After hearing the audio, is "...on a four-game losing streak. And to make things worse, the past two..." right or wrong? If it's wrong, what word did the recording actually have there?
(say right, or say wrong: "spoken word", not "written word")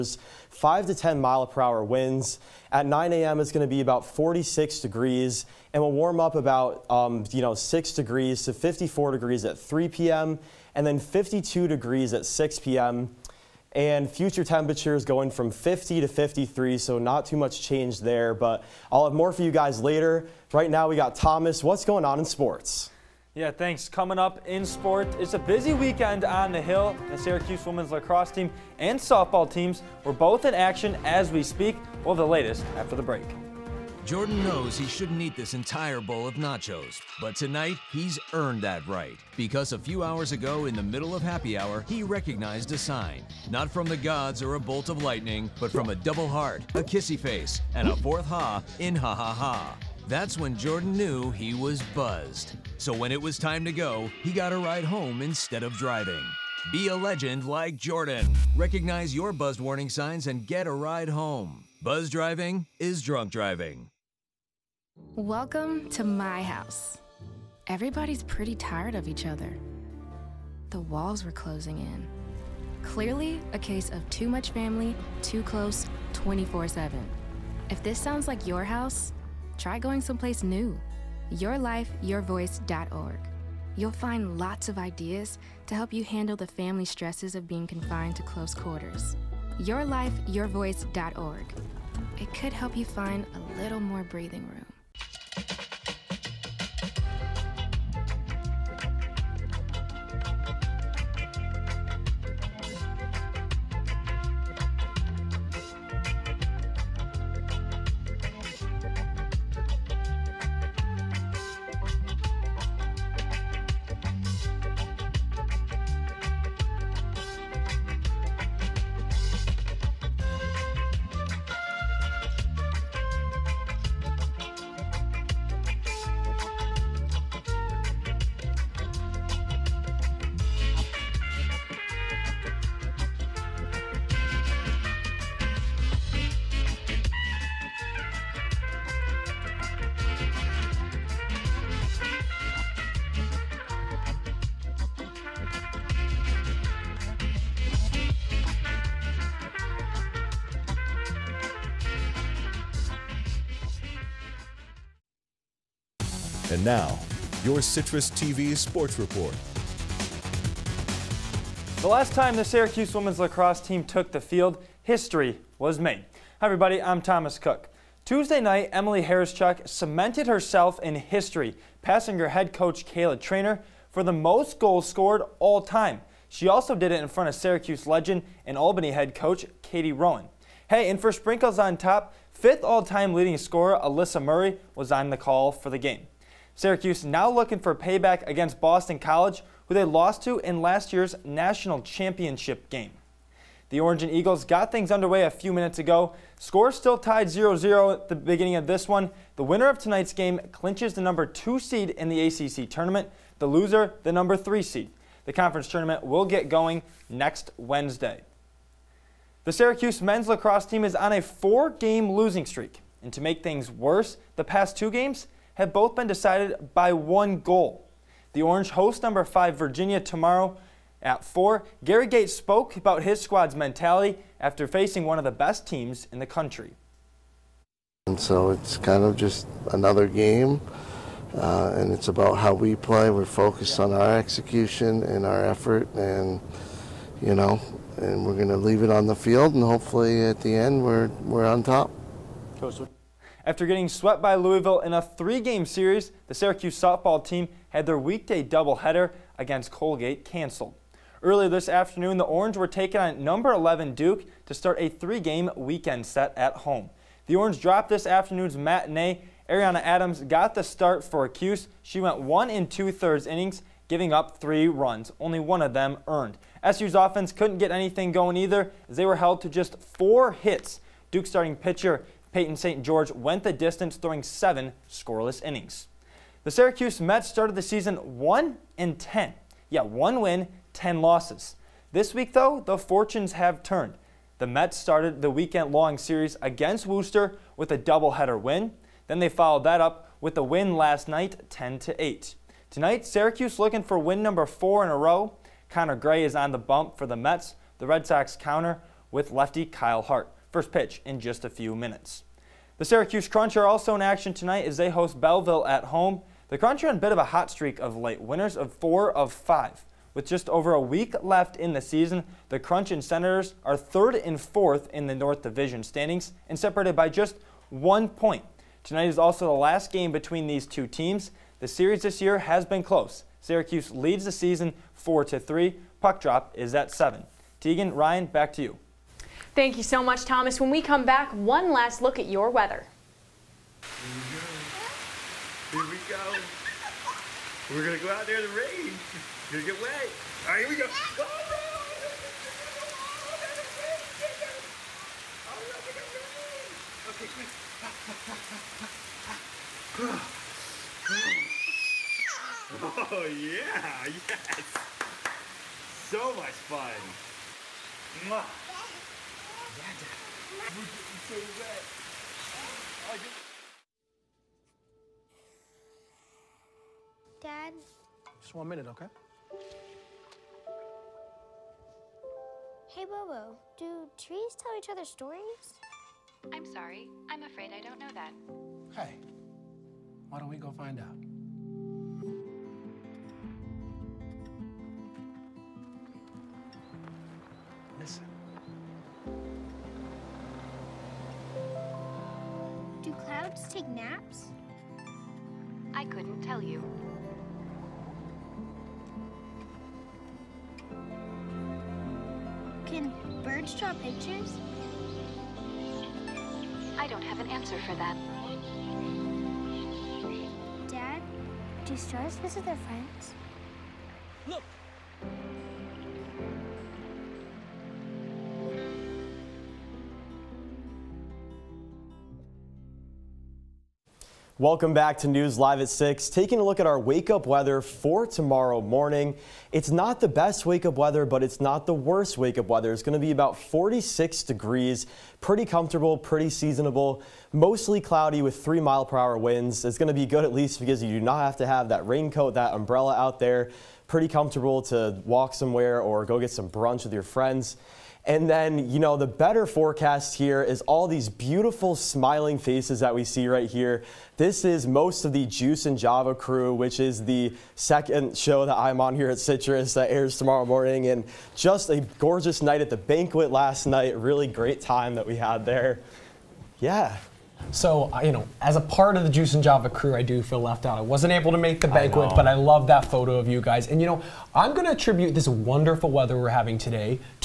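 right.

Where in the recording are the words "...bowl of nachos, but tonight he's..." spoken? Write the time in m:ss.
0:35.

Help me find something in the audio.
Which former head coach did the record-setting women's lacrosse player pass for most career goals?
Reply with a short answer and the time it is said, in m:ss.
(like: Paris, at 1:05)
Kayla Treanor, at 2:52.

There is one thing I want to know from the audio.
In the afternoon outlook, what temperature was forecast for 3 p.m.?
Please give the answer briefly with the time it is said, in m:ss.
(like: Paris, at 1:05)
54 degrees, at 0:08.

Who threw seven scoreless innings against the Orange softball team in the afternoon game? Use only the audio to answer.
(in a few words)
Peyton St. George.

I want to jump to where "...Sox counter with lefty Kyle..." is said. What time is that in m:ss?
4:58.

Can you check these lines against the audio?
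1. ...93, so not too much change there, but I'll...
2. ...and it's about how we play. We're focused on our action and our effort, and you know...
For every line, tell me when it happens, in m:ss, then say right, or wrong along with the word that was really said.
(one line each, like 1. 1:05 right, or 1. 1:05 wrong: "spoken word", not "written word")
1. 0:16 wrong: "53", not "93"
2. 3:51 wrong: "execution", not "action".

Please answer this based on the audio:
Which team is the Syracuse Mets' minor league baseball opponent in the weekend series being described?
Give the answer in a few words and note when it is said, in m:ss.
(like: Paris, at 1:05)
Worcester, at 4:46.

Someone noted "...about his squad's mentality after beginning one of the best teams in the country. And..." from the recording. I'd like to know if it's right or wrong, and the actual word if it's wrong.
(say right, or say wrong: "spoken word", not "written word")
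wrong: "facing", not "beginning".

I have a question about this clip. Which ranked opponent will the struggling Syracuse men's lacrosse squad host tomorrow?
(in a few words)
Virginia.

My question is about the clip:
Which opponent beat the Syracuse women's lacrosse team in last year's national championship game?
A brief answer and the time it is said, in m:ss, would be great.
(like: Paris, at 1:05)
Boston College, at 3:08.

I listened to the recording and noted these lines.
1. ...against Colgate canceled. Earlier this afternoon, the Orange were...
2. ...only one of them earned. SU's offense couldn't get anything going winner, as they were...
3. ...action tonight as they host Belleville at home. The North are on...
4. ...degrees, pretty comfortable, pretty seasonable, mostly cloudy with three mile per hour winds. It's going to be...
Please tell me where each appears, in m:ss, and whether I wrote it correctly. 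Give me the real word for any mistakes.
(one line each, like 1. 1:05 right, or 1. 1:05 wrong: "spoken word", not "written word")
1. 4:09 right
2. 4:25 wrong: "either", not "winner"
3. 5:04 wrong: "Crunch", not "North"
4. 7:14 right.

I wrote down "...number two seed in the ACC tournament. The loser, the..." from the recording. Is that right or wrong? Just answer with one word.
right.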